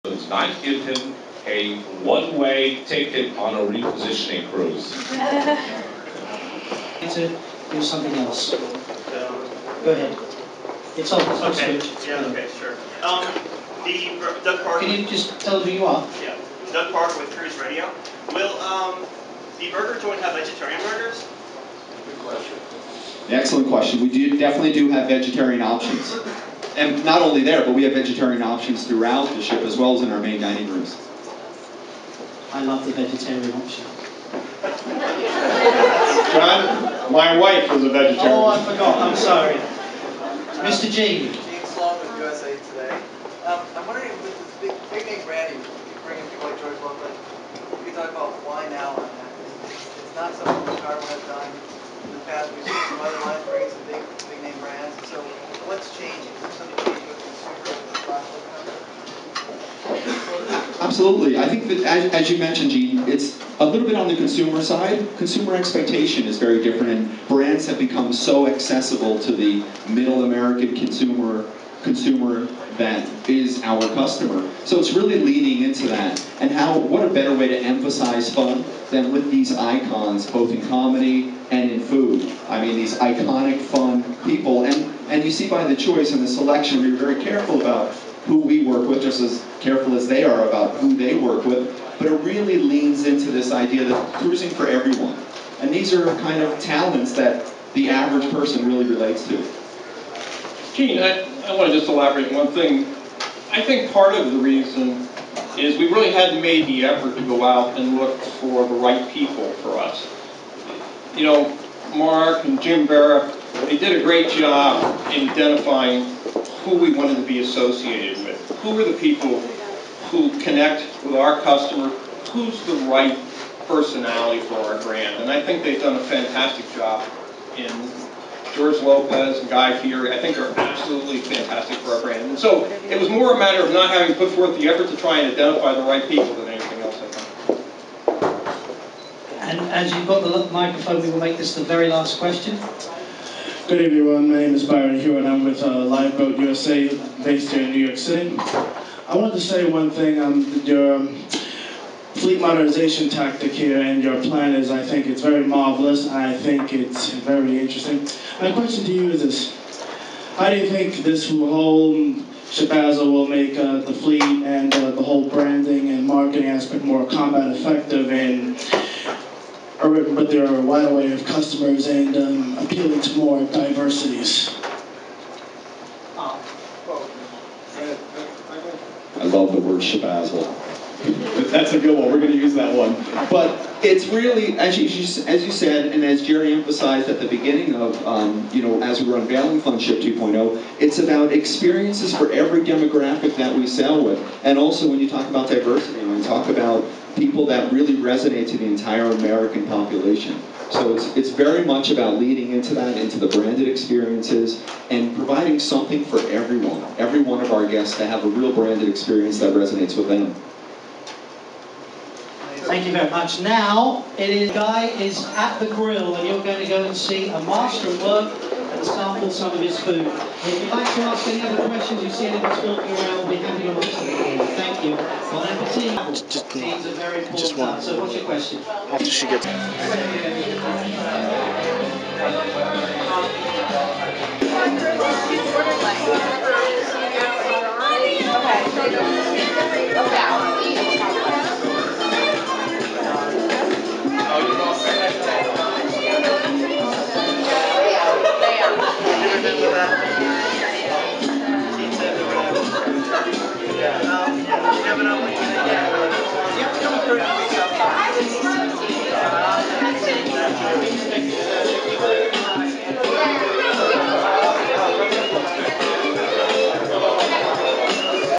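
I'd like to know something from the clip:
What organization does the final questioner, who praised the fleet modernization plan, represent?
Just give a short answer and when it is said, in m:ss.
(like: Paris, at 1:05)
Liveboat USA, at 2:25.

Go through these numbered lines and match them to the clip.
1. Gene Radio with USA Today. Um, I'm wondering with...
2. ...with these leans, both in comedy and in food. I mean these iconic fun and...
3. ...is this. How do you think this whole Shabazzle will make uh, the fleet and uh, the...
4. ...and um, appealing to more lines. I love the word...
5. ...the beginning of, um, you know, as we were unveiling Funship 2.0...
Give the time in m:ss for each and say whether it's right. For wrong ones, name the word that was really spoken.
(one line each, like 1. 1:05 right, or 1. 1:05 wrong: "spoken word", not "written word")
1. 0:41 wrong: "Sloan", not "Radio"
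2. 1:19 wrong: "icons", not "leans"
3. 2:39 right
4. 2:51 wrong: "diversities", not "lines"
5. 3:07 right.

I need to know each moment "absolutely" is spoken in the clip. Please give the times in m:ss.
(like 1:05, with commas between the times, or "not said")
1:00, 2:10.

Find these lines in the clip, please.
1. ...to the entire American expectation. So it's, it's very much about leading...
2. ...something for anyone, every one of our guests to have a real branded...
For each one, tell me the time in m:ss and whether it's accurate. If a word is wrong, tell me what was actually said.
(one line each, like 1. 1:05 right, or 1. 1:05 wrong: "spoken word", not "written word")
1. 3:18 wrong: "population", not "expectation"
2. 3:25 wrong: "everyone", not "anyone".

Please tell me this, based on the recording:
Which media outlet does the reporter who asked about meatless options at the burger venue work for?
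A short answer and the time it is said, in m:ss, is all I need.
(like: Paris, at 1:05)
Cruise Radio, at 0:17.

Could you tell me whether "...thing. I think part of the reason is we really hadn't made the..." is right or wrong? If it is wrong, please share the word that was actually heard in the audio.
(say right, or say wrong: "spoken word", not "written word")
right.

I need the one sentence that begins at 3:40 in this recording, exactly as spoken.
If you'd like to ask any other questions, you see anyone stalking around, we'll be happy to answer them.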